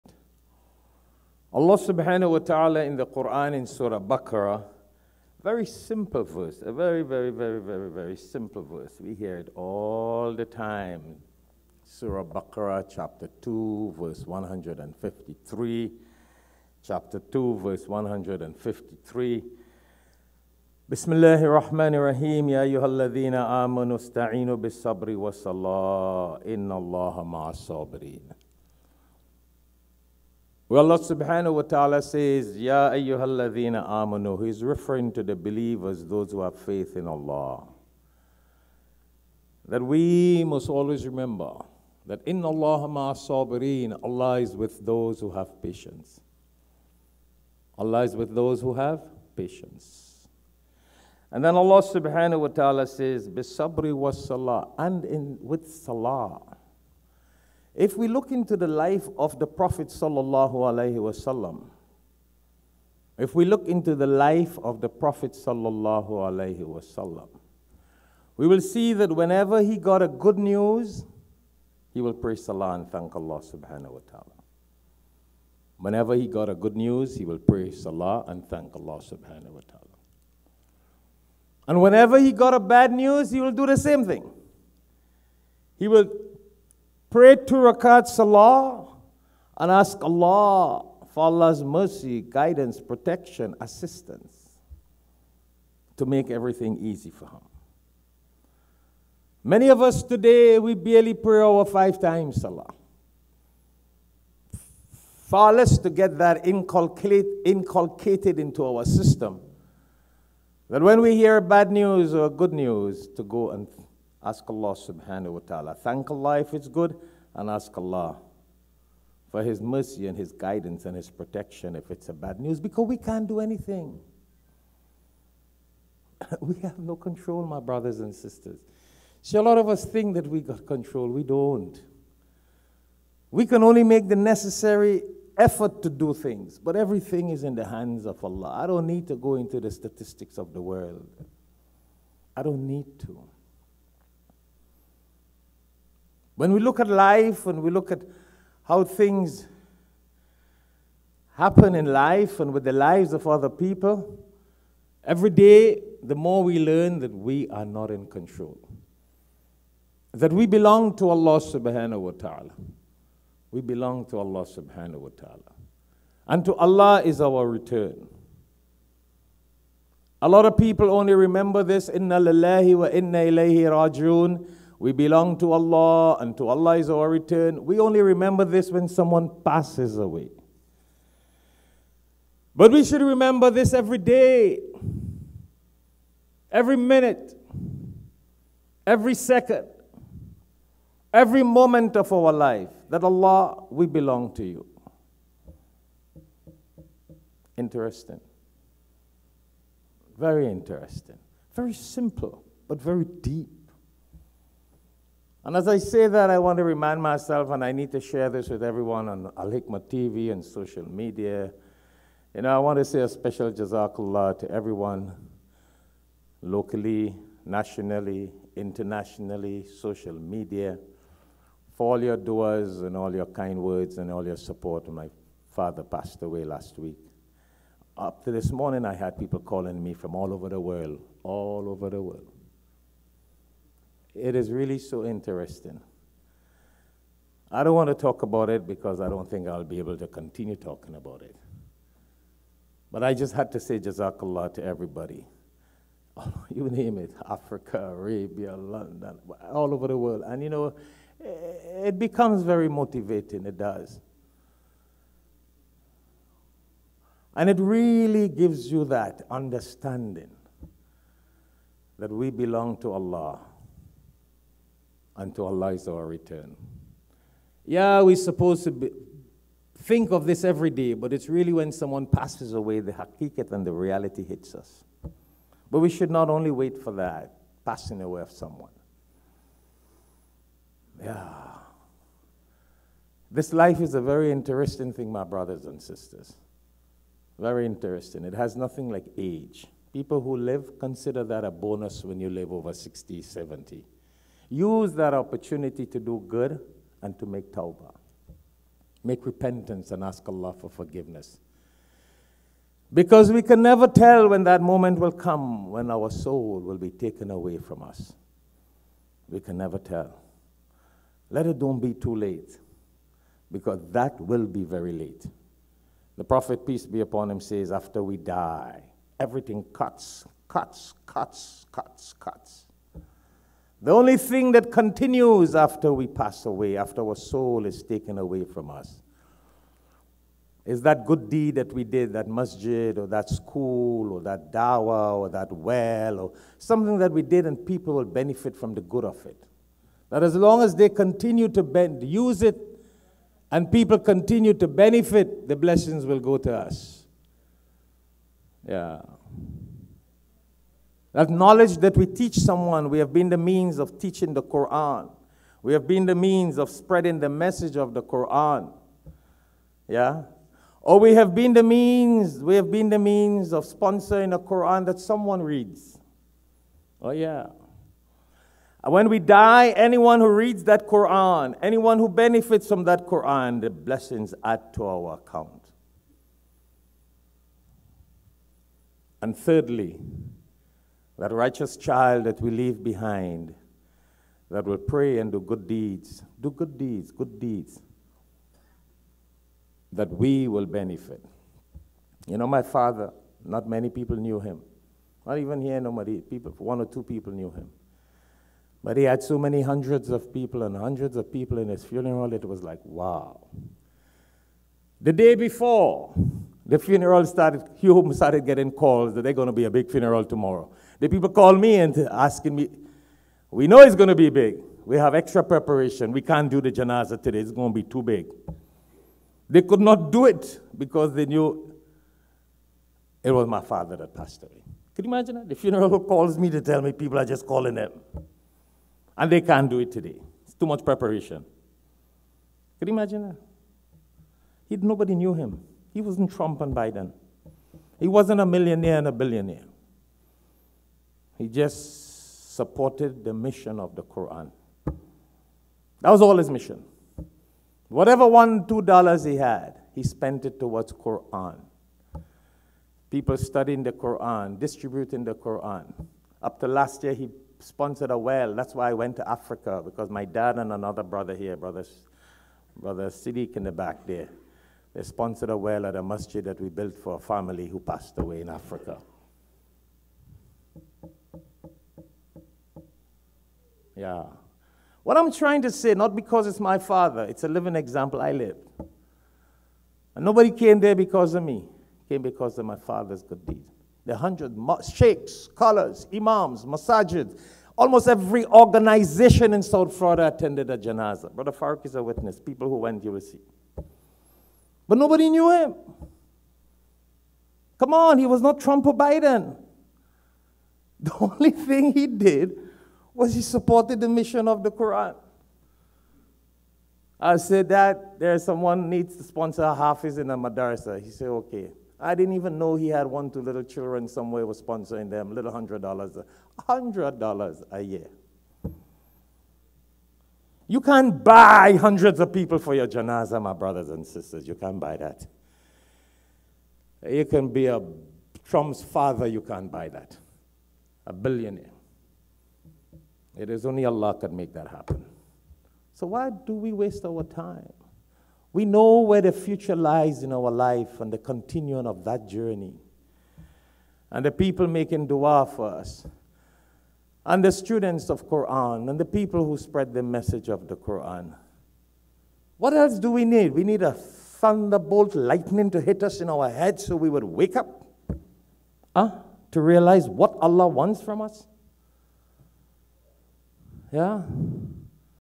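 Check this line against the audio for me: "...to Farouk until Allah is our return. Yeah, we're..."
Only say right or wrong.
wrong.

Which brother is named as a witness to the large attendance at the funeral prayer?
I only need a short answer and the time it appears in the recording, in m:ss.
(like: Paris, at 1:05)
Farouk, at 8:11.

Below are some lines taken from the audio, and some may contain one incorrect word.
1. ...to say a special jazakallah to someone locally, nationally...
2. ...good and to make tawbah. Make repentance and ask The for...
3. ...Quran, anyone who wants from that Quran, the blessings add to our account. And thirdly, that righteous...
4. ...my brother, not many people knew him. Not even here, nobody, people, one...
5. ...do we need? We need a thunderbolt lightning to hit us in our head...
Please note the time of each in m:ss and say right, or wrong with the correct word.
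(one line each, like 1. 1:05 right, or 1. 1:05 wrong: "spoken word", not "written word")
1. 3:32 wrong: "everyone", not "someone"
2. 4:56 wrong: "Allah", not "The"
3. 6:10 wrong: "benefits", not "wants"
4. 6:32 wrong: "father", not "brother"
5. 9:12 right.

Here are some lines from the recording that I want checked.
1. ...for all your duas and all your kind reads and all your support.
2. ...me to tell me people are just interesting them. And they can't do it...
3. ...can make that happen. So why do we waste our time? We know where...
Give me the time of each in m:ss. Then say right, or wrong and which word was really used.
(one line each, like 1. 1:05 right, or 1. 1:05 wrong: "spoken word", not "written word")
1. 3:41 wrong: "words", not "reads"
2. 7:06 wrong: "calling", not "interesting"
3. 8:54 right.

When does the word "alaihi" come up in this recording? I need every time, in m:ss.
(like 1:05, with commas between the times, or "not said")
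1:00, 1:06.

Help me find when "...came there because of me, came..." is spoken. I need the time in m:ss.
8:00.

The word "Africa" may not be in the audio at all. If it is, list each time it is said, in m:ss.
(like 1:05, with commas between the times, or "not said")
4:07, 7:39, 7:48.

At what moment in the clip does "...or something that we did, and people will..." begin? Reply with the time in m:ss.
5:36.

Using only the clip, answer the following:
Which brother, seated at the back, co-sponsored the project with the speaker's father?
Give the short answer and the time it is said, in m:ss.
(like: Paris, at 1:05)
Siddiq, at 7:42.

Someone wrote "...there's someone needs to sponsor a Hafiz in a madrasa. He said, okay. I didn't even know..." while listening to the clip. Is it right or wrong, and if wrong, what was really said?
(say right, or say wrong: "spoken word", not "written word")
right.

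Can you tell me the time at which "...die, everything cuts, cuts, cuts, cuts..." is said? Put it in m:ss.
5:18.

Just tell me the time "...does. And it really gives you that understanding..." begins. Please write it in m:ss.
4:13.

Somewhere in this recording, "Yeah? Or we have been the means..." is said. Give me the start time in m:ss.
5:59.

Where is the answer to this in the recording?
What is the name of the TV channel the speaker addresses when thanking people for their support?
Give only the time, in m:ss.
3:29.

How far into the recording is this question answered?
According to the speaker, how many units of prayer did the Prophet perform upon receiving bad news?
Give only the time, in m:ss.
1:27.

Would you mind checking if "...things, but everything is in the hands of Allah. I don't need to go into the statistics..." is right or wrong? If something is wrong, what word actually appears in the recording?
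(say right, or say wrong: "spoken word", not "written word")
right.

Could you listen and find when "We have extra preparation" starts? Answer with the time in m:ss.
6:54.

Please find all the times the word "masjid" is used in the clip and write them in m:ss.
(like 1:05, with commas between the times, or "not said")
5:32, 7:46.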